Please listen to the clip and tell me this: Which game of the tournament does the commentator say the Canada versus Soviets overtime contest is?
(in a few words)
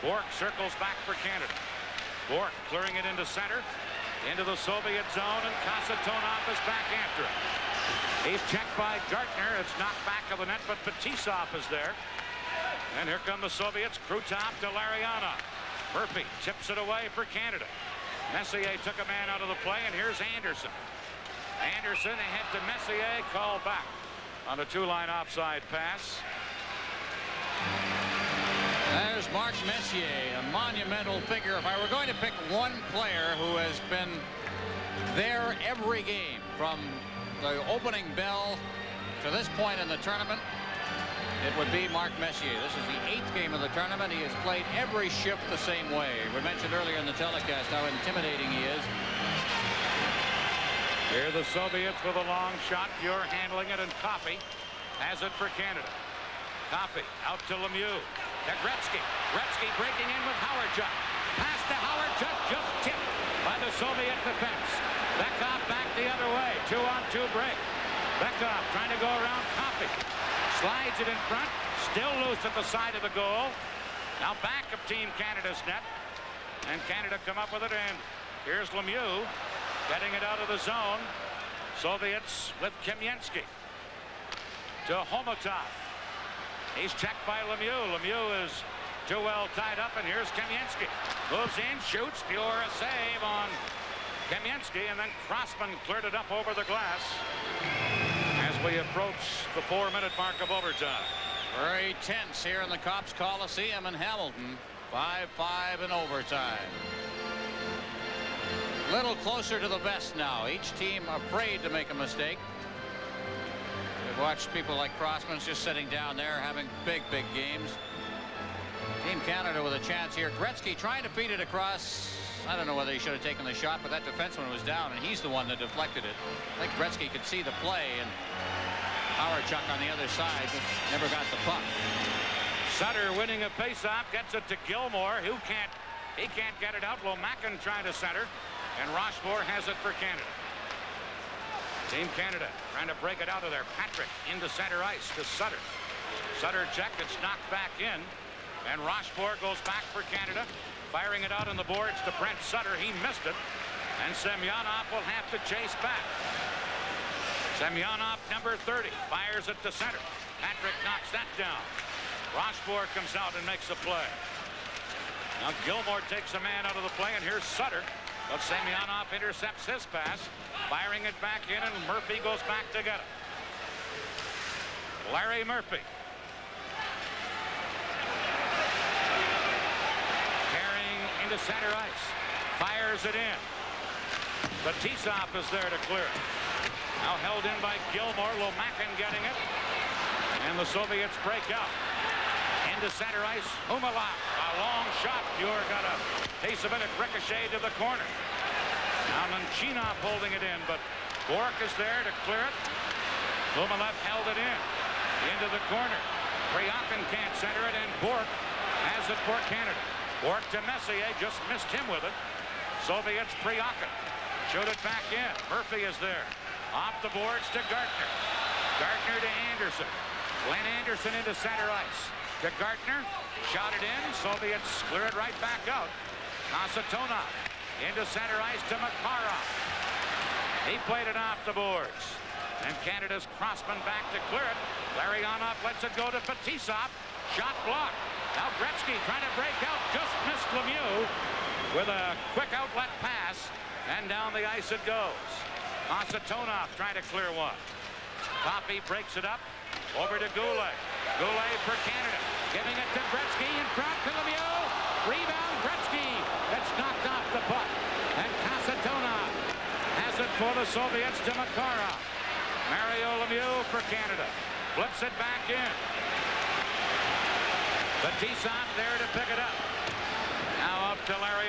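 8th.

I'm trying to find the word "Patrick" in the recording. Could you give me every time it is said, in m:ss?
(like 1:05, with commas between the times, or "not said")
2:23, 2:40.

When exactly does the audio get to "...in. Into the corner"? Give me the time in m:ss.
3:24.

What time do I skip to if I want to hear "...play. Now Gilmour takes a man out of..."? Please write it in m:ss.
2:43.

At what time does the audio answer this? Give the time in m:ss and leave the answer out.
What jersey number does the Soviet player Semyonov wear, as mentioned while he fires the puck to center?
2:38.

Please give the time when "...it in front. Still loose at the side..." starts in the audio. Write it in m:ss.
1:10.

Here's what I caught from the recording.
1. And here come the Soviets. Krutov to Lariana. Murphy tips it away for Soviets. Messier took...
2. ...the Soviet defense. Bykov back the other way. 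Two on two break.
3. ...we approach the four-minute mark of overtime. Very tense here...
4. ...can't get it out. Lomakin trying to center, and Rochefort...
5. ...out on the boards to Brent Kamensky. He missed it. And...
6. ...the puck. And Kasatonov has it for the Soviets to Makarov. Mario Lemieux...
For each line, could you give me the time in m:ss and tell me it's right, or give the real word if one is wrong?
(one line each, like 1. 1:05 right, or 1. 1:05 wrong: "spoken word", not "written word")
1. 0:12 wrong: "Canada", not "Soviets"
2. 1:03 right
3. 1:38 right
4. 2:16 right
5. 2:31 wrong: "Sutter", not "Kamensky"
6. 4:17 right.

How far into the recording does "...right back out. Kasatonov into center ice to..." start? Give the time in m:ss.
3:45.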